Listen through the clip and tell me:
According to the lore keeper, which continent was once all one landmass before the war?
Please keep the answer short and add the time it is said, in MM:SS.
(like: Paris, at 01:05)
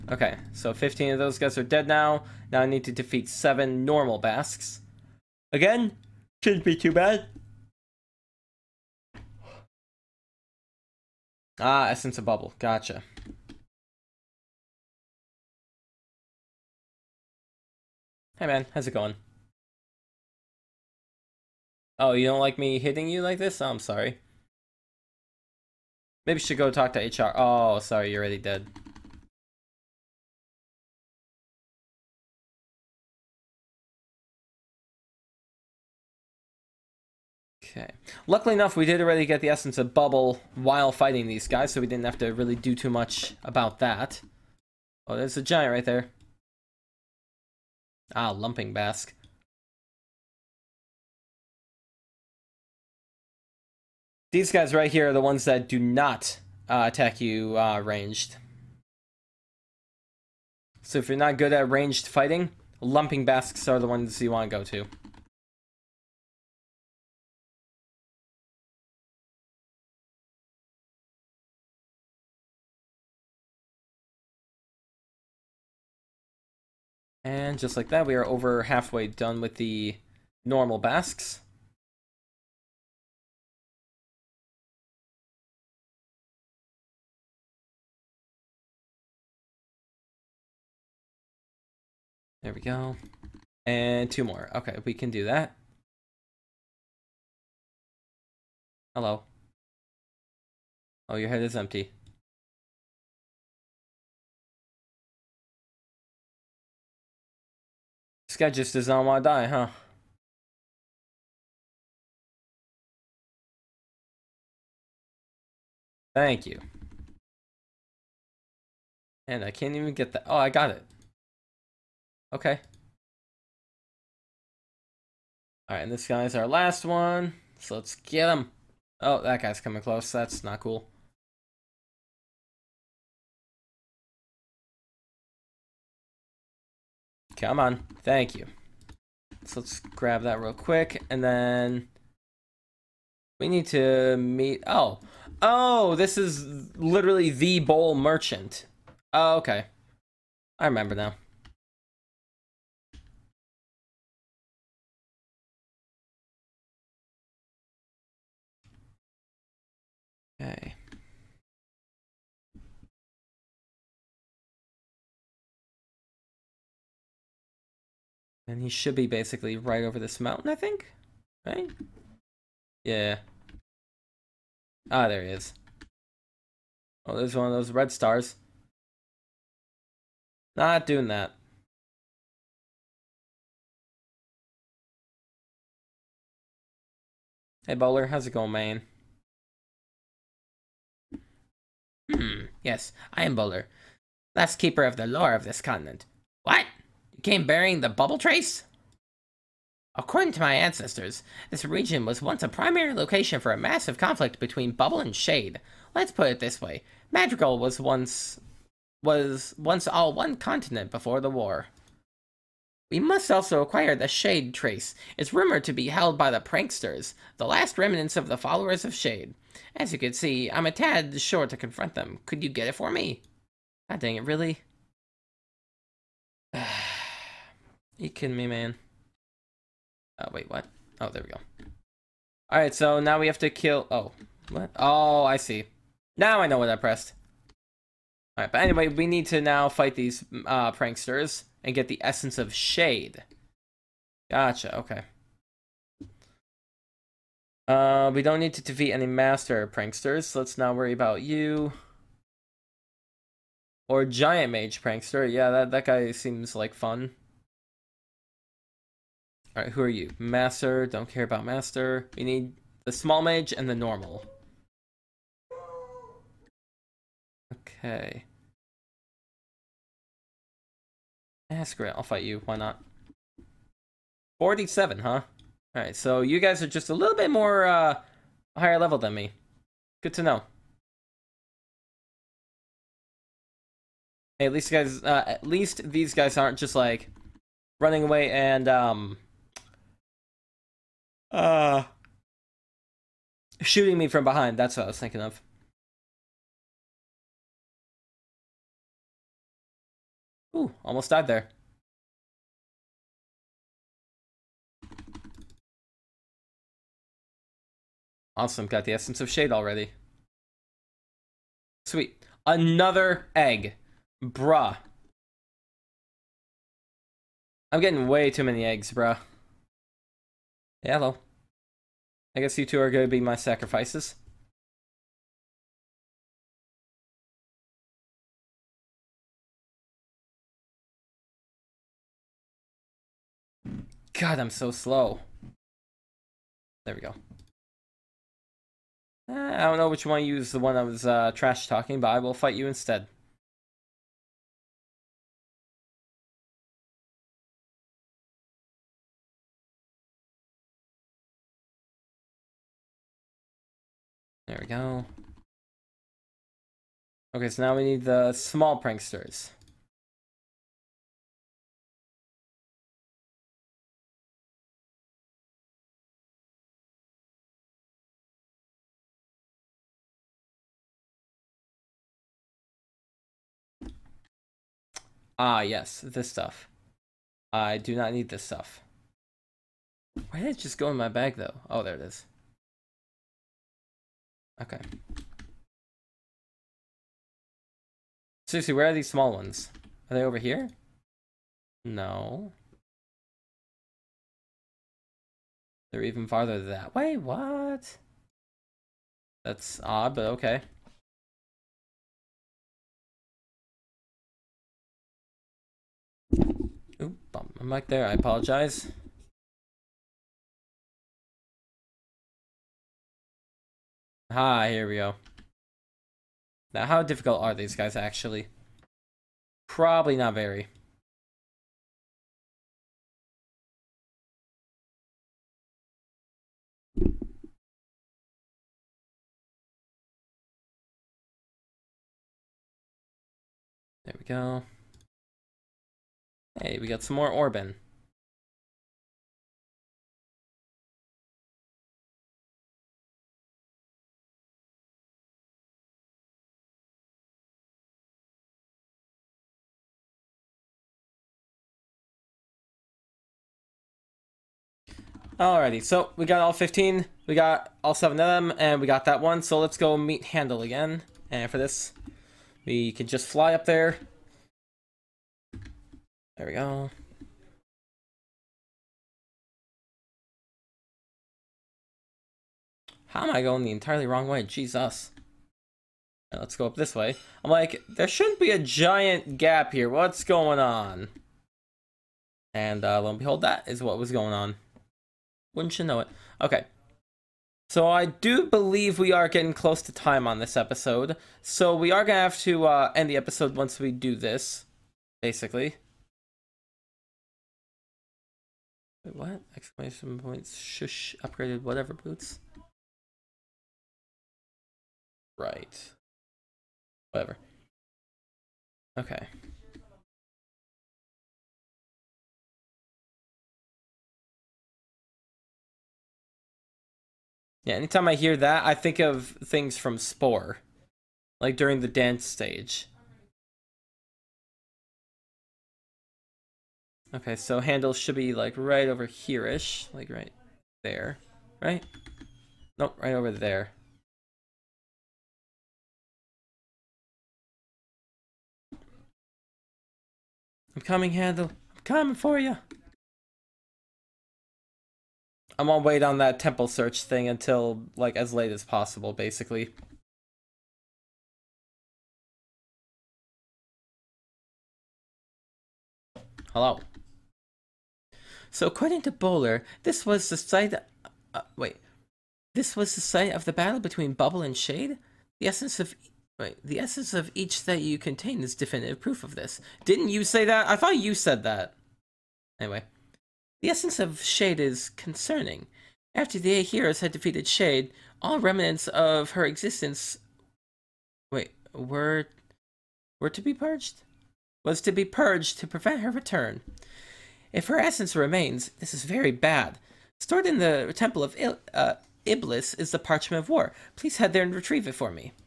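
Madrigal, at 03:27.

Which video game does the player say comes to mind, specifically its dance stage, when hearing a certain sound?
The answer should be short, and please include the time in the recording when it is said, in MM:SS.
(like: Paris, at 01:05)
Spore, at 08:39.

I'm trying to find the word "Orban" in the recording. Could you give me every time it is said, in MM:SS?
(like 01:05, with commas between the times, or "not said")
07:17.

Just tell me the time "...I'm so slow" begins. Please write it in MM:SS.
05:34.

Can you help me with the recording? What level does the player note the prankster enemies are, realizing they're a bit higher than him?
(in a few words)
47.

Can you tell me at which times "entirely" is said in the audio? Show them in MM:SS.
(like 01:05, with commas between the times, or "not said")
07:53.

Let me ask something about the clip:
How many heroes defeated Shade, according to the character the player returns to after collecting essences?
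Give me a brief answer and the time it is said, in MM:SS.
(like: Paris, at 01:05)
8, at 09:36.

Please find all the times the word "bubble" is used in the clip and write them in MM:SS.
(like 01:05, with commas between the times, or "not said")
00:12, 00:39, 03:17, 03:24, 09:24.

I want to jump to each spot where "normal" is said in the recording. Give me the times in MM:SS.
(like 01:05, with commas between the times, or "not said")
00:03, 01:20, 04:23.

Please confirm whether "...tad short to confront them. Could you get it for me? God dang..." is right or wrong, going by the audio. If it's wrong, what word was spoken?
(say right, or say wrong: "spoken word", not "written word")
right.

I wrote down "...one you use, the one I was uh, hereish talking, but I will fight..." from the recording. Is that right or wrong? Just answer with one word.
wrong.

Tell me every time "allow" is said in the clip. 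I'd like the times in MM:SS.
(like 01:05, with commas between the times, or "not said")
not said.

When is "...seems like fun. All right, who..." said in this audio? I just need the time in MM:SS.
04:16.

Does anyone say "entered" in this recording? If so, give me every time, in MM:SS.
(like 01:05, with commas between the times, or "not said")
not said.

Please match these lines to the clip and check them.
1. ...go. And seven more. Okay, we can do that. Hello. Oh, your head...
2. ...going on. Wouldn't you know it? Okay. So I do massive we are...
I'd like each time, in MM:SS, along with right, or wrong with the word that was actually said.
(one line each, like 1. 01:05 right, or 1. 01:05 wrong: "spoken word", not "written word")
1. 01:32 wrong: "two", not "seven"
2. 08:04 wrong: "believe", not "massive".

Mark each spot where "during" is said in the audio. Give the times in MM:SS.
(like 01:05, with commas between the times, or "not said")
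08:41.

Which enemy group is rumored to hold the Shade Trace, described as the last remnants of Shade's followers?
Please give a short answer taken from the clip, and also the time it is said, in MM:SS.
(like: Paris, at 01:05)
The pranksters, at 03:36.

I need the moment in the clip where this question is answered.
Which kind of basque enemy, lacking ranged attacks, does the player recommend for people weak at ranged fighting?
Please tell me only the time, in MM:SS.
00:48.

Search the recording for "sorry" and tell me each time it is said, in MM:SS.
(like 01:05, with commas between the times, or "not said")
00:23, 00:27.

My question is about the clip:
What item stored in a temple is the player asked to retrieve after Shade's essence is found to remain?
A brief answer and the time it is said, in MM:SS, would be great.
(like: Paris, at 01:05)
Parchment of War, at 09:52.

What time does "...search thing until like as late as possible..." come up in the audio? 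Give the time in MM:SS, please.
09:06.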